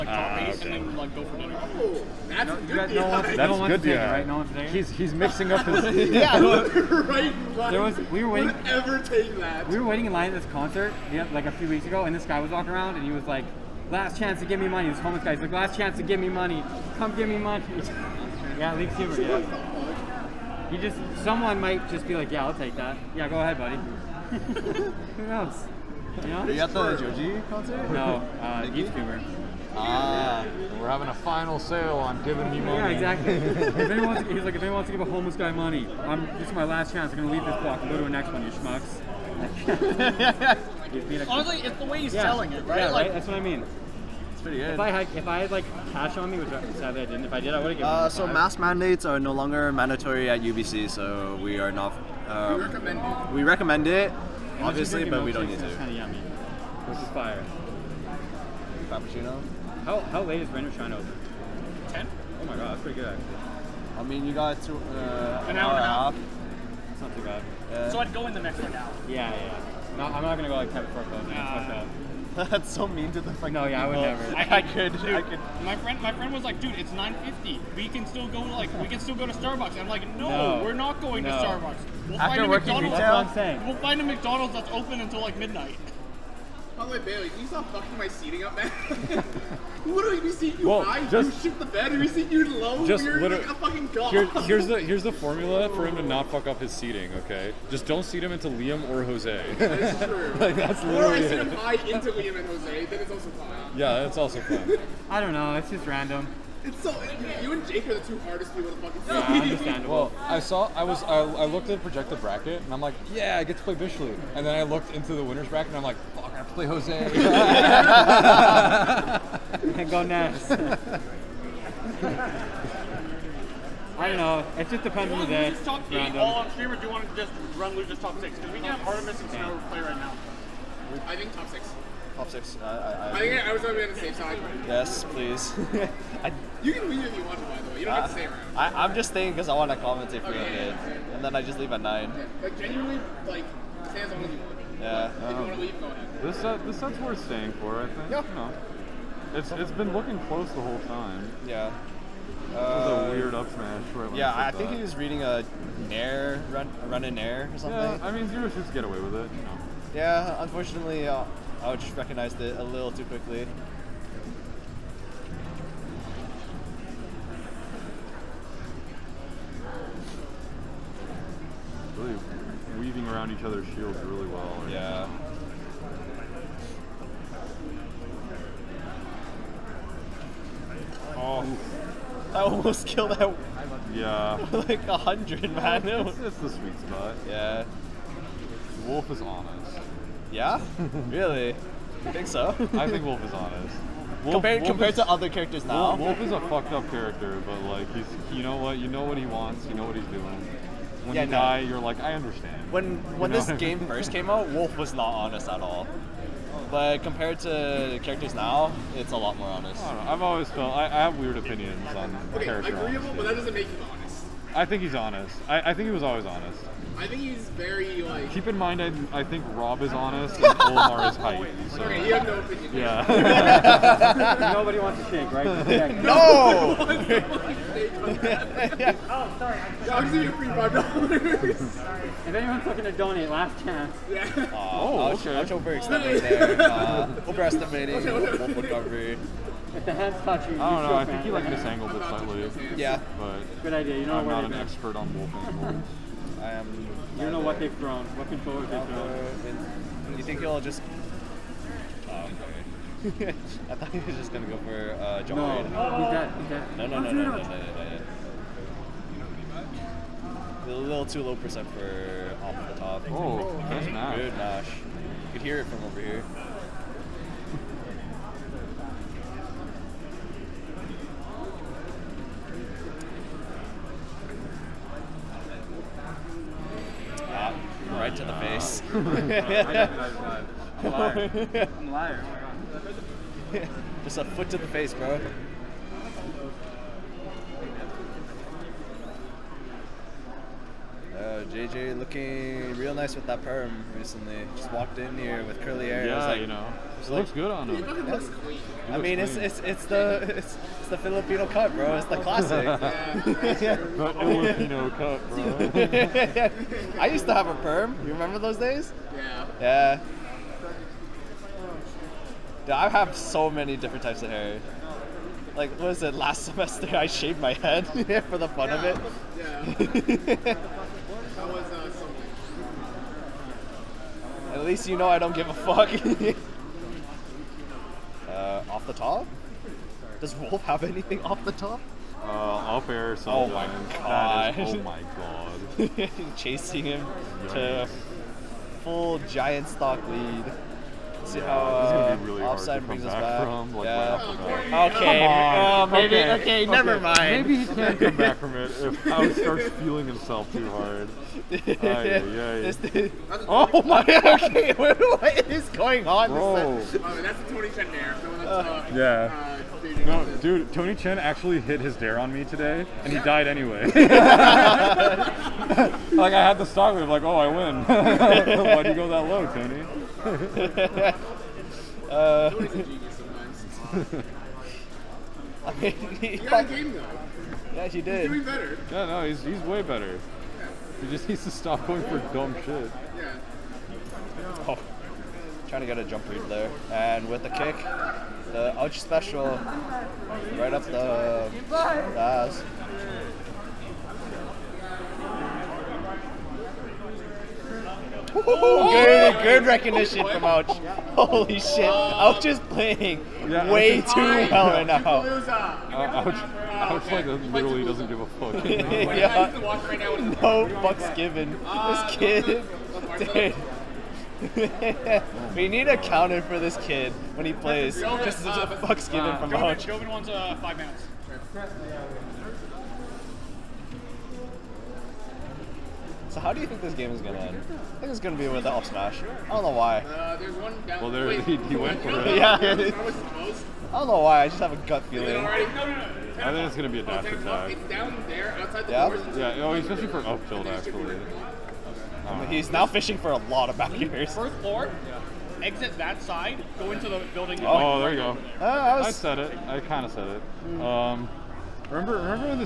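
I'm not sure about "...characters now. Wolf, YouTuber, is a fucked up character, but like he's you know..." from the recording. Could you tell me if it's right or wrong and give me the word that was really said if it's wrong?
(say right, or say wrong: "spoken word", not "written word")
wrong: "Wolf", not "YouTuber".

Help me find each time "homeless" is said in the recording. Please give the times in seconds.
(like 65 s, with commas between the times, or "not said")
14 s, 35 s.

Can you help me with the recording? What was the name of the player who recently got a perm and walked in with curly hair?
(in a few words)
JJ.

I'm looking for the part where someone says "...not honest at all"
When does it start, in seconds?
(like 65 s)
204 s.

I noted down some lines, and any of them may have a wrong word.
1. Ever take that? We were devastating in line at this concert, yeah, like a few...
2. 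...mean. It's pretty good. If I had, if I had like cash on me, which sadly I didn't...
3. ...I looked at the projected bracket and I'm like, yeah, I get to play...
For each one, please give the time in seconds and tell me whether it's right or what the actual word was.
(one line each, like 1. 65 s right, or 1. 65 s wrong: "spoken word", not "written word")
1. 8 s wrong: "waiting", not "devastating"
2. 43 s right
3. 111 s right.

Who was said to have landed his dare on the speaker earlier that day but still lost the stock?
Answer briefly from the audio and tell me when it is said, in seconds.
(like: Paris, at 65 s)
Tony Chen, at 360 s.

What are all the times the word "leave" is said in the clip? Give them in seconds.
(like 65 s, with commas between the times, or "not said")
37 s, 136 s, 141 s.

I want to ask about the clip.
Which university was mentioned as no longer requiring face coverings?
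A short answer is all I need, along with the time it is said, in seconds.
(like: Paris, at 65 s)
UBC, at 50 s.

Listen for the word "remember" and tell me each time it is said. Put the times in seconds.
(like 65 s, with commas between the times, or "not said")
308 s, 451 s.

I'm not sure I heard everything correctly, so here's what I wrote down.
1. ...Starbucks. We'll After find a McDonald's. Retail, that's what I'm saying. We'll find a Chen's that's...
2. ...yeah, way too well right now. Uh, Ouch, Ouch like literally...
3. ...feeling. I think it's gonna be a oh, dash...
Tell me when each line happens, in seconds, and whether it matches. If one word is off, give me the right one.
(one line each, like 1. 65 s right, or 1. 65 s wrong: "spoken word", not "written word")
1. 81 s wrong: "McDonald", not "Chen"
2. 403 s right
3. 435 s right.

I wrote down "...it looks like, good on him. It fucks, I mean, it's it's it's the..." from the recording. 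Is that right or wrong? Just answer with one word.
wrong.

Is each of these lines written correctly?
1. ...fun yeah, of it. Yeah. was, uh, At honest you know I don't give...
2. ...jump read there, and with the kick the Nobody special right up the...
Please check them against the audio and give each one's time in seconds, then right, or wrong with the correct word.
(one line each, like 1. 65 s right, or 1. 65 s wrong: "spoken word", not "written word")
1. 318 s wrong: "least", not "honest"
2. 386 s wrong: "Ouch", not "Nobody".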